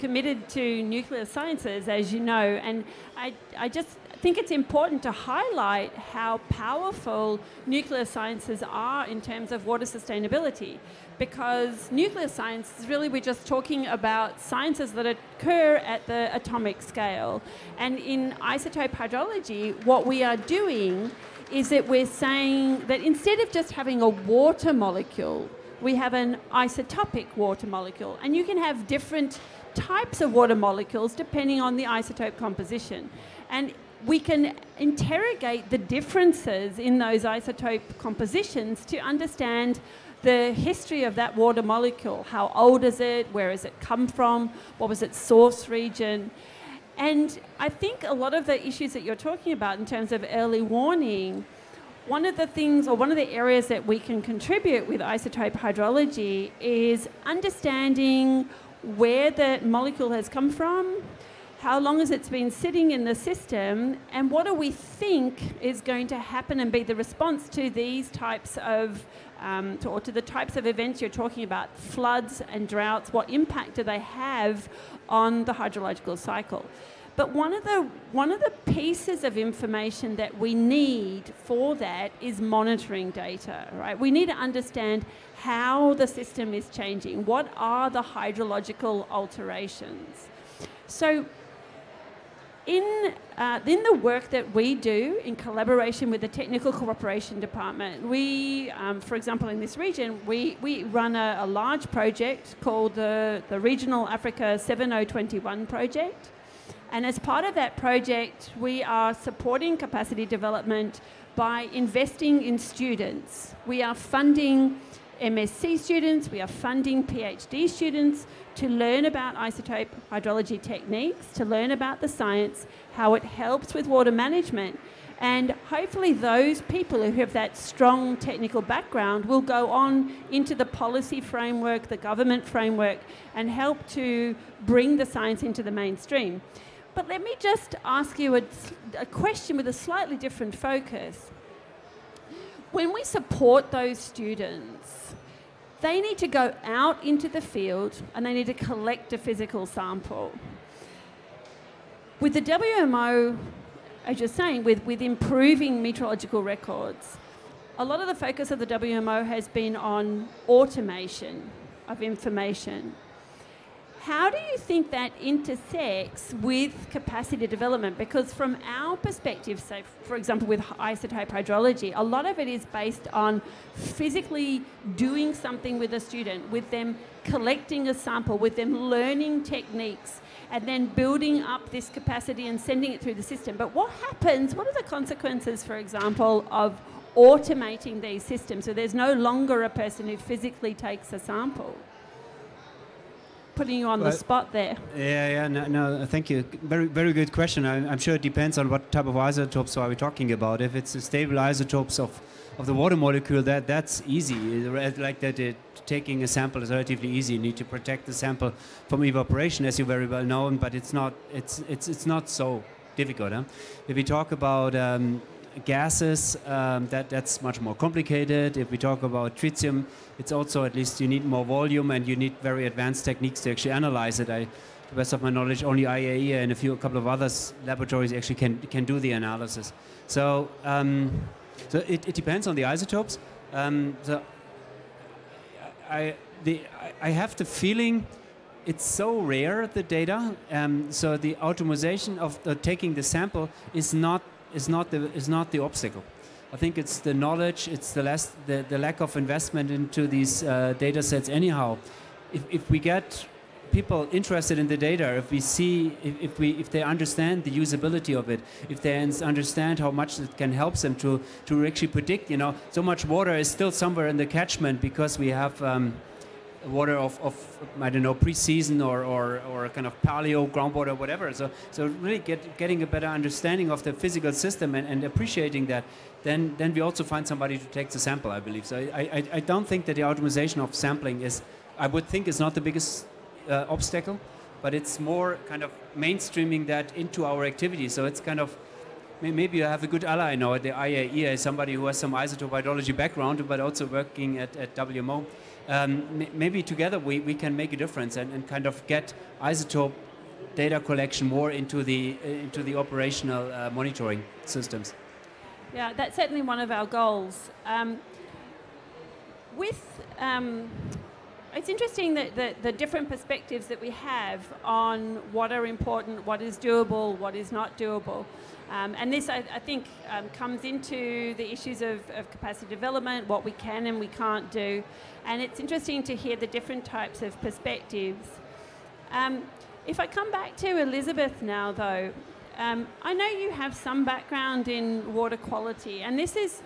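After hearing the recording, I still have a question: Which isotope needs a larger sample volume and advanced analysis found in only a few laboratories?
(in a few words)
Tritium.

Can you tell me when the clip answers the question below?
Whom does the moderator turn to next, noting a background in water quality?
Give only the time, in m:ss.
5:30.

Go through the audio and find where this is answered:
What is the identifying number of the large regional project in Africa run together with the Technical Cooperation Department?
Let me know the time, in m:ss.
1:44.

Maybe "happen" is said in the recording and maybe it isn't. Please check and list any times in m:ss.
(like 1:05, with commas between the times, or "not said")
1:06, 3:03.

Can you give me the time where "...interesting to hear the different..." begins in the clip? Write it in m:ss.
5:25.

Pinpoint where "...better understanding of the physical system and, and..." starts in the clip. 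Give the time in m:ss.
4:32.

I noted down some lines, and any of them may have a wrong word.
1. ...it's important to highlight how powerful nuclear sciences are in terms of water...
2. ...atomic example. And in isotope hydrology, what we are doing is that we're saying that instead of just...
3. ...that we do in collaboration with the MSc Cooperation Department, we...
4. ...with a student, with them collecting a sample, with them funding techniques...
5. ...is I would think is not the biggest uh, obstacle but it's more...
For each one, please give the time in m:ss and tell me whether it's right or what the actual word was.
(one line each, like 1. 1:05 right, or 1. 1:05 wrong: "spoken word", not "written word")
1. 0:04 right
2. 0:16 wrong: "scale", not "example"
3. 1:34 wrong: "Technical", not "MSc"
4. 2:55 wrong: "learning", not "funding"
5. 4:41 right.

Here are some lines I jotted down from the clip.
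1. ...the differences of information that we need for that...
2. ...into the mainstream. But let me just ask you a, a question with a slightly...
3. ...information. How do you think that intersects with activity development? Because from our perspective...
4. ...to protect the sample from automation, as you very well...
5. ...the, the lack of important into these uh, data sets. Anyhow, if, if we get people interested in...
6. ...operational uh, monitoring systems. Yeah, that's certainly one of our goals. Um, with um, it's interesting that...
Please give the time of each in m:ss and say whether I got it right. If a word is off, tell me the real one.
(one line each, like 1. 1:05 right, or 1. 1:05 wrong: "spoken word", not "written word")
1. 1:18 wrong: "pieces", not "differences"
2. 2:15 right
3. 2:42 wrong: "capacity", not "activity"
4. 3:27 wrong: "evaporation", not "automation"
5. 4:08 wrong: "investment", not "important"
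6. 5:02 right.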